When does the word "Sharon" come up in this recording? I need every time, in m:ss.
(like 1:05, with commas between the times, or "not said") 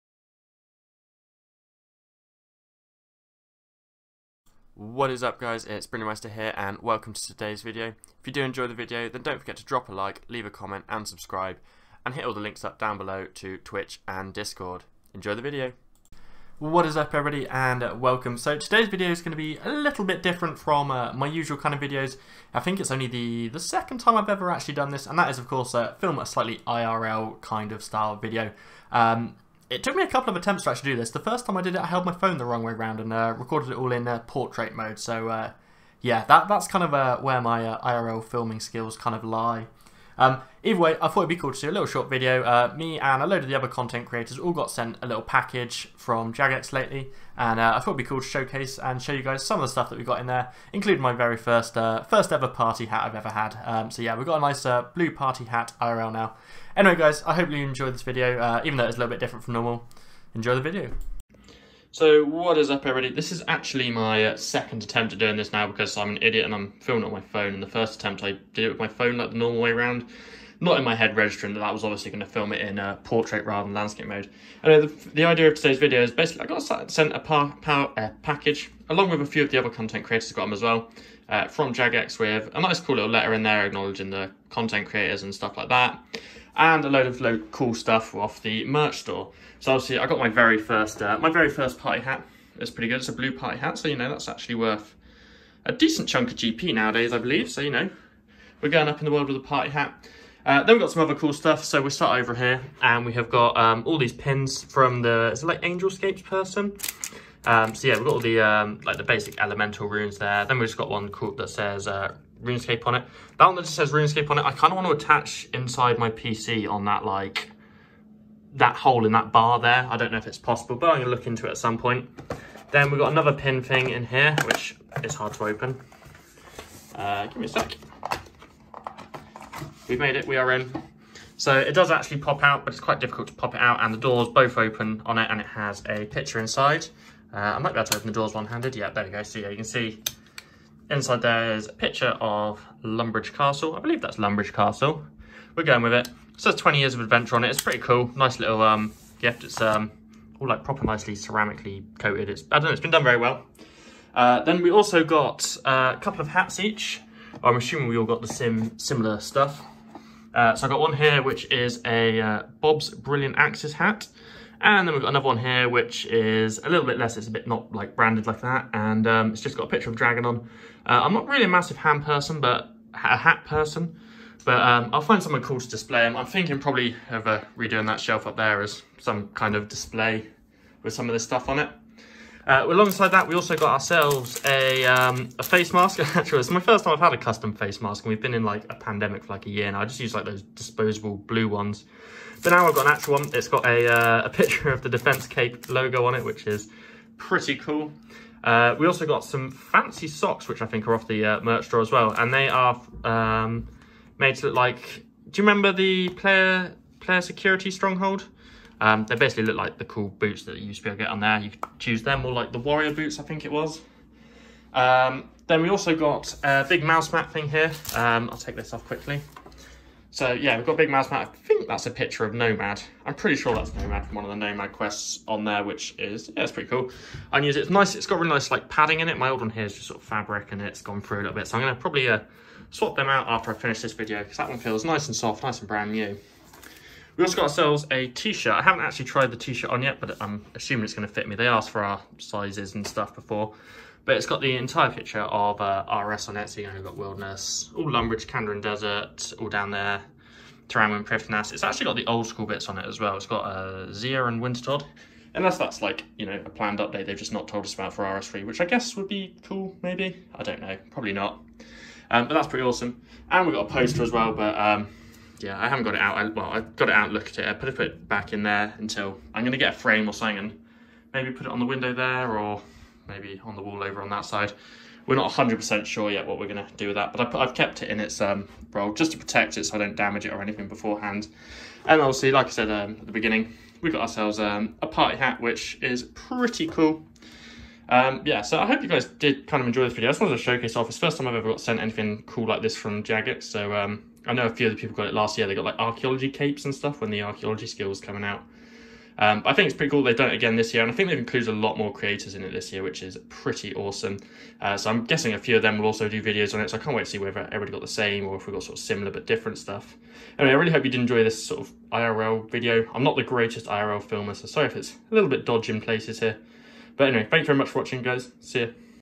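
not said.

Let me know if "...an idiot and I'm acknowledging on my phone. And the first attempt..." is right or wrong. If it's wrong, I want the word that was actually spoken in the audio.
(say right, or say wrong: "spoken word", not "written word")
wrong: "filming", not "acknowledging".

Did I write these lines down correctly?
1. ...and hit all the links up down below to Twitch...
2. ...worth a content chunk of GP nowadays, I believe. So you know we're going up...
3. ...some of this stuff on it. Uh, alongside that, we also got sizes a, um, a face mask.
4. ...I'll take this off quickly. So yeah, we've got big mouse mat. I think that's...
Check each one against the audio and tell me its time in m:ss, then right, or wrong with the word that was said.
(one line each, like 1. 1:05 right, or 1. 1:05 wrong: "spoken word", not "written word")
1. 0:12 right
2. 1:34 wrong: "decent", not "content"
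3. 3:00 wrong: "ourselves", not "sizes"
4. 3:38 right.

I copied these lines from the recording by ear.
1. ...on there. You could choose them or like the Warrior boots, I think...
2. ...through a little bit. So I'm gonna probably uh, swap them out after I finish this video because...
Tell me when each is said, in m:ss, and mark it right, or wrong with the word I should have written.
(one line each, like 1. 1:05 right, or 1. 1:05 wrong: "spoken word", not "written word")
1. 3:31 right
2. 3:51 right.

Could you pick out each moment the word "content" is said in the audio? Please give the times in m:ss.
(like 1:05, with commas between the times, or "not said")
0:43, 1:19, 1:24.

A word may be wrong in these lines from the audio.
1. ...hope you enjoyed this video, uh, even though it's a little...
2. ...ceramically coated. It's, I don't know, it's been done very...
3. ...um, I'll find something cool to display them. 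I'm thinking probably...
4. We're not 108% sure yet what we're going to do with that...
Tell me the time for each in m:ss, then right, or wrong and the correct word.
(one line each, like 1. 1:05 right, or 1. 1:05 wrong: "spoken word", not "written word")
1. 0:57 right
2. 2:31 right
3. 2:54 right
4. 4:35 wrong: "100", not "108".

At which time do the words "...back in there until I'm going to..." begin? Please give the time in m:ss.
4:28.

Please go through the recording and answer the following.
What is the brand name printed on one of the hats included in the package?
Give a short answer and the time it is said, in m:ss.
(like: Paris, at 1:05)
Bob's Brilliant Axes, at 2:42.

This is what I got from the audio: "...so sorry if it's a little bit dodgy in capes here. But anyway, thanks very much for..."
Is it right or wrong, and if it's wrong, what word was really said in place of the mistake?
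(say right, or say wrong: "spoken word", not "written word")
wrong: "places", not "capes".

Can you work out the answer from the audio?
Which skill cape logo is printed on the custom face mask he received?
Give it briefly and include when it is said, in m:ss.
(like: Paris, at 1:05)
Defence Cape, at 3:14.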